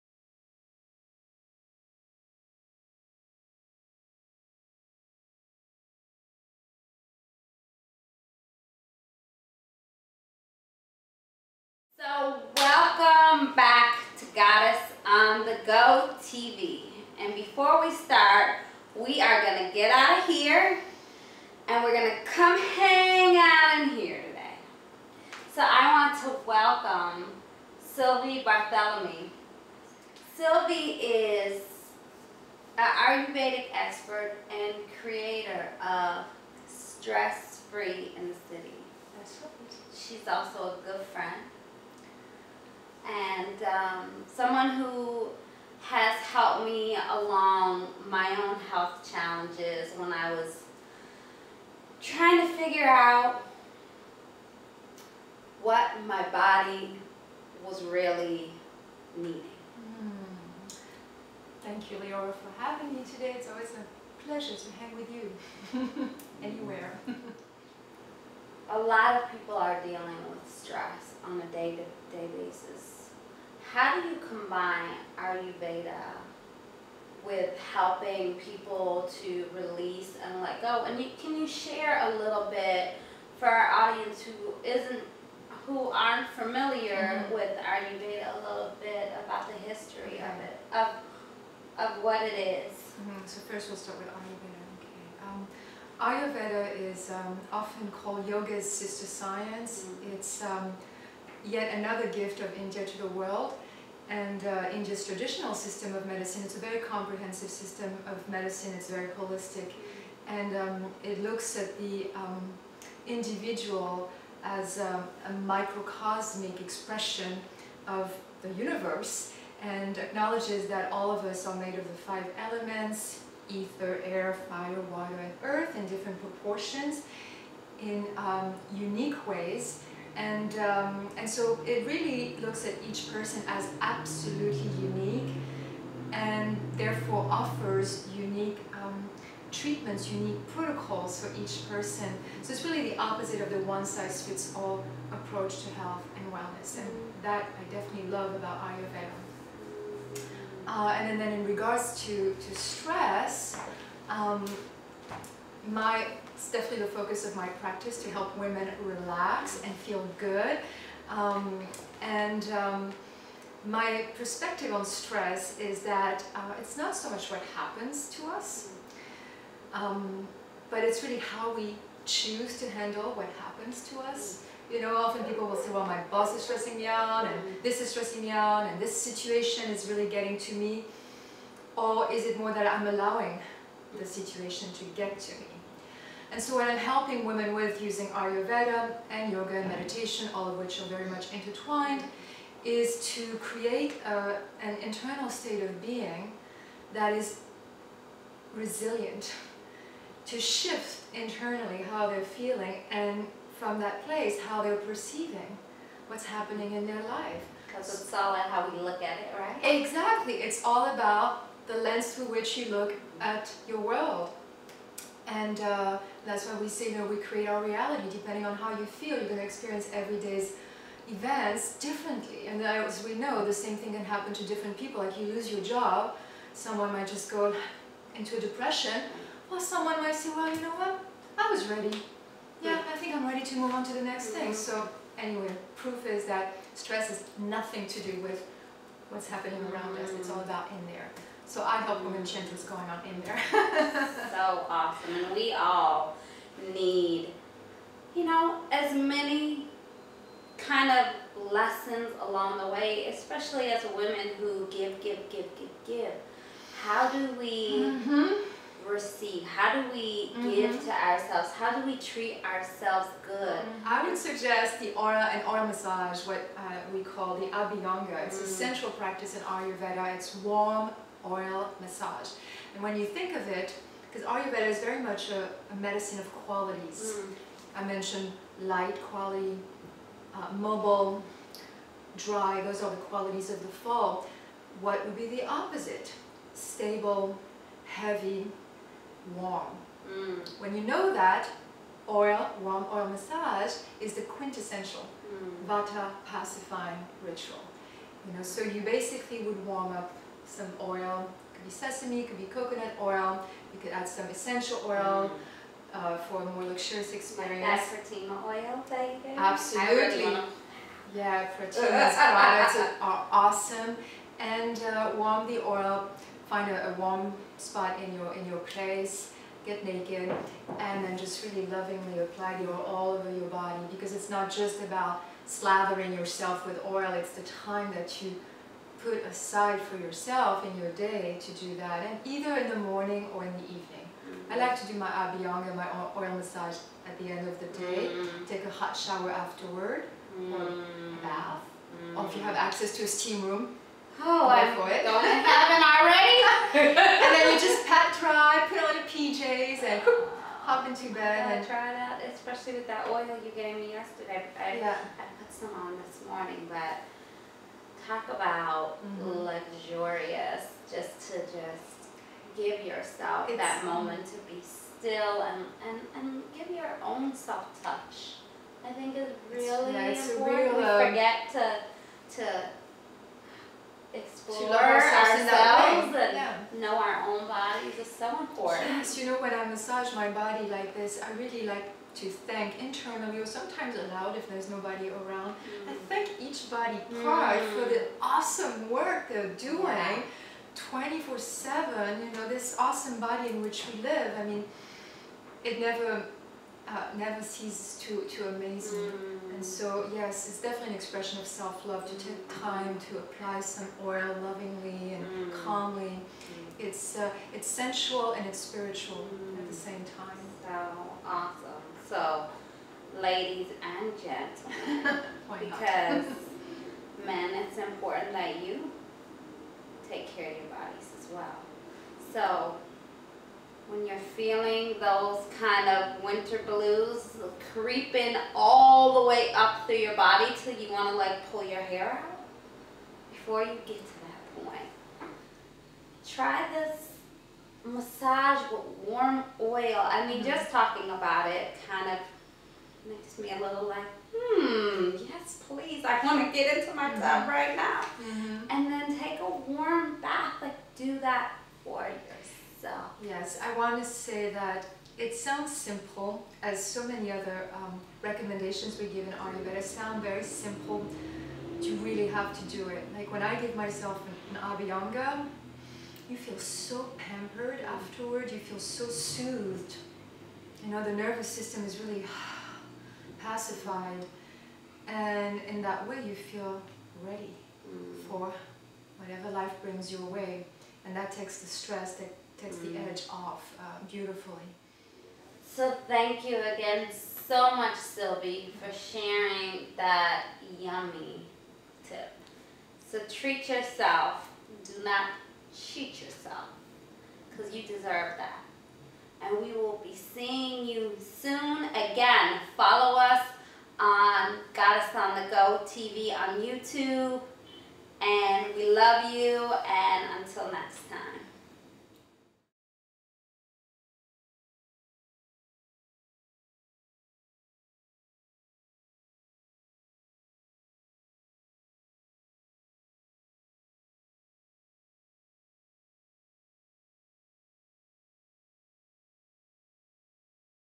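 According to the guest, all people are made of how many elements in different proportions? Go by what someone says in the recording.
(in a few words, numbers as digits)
5.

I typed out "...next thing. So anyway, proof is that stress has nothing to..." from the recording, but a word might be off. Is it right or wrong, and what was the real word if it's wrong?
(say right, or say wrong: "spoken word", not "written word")
right.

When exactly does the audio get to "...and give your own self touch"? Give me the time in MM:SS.
06:06.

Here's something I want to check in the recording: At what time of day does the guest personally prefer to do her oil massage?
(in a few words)
end of the day.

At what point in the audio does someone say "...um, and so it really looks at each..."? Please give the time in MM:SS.
02:10.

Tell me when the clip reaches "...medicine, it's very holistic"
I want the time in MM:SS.
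01:48.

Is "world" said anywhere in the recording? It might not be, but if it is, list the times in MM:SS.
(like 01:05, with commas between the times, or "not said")
01:43, 03:33.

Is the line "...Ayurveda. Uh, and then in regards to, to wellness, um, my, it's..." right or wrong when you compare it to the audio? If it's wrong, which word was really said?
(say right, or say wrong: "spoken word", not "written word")
wrong: "stress", not "wellness".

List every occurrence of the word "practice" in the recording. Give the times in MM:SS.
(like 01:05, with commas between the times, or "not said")
02:37, 04:28.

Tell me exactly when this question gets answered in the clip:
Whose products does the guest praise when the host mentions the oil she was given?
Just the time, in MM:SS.
05:11.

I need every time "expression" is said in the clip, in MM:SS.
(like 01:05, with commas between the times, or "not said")
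01:56, 06:40.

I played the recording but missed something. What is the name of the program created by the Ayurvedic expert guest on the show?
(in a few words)
Stress Free in the City.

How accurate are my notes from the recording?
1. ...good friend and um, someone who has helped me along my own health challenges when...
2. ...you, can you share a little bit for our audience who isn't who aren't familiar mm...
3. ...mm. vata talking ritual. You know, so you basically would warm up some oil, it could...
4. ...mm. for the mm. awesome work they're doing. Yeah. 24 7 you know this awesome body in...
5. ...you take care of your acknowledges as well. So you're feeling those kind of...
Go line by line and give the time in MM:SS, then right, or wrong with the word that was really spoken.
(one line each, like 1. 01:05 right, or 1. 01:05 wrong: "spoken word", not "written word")
1. 00:40 right
2. 01:20 right
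3. 04:55 wrong: "pacifying", not "talking"
4. 06:27 right
5. 06:58 wrong: "bodies", not "acknowledges".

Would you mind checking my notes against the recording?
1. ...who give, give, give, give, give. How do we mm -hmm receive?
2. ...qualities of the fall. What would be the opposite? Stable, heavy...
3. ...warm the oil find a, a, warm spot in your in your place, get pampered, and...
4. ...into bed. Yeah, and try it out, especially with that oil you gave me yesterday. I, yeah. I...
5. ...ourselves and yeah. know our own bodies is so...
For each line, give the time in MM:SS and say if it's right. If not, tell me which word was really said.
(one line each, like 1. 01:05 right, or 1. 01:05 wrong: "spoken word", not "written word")
1. 04:14 right
2. 04:43 right
3. 05:15 wrong: "naked", not "pampered"
4. 05:50 right
5. 06:15 right.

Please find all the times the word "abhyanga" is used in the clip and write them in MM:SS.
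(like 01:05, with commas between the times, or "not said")
04:27, 05:35, 07:44.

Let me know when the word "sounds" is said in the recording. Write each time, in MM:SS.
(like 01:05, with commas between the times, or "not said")
07:35, 07:39.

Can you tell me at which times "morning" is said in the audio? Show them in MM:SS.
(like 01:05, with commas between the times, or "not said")
05:32, 05:56.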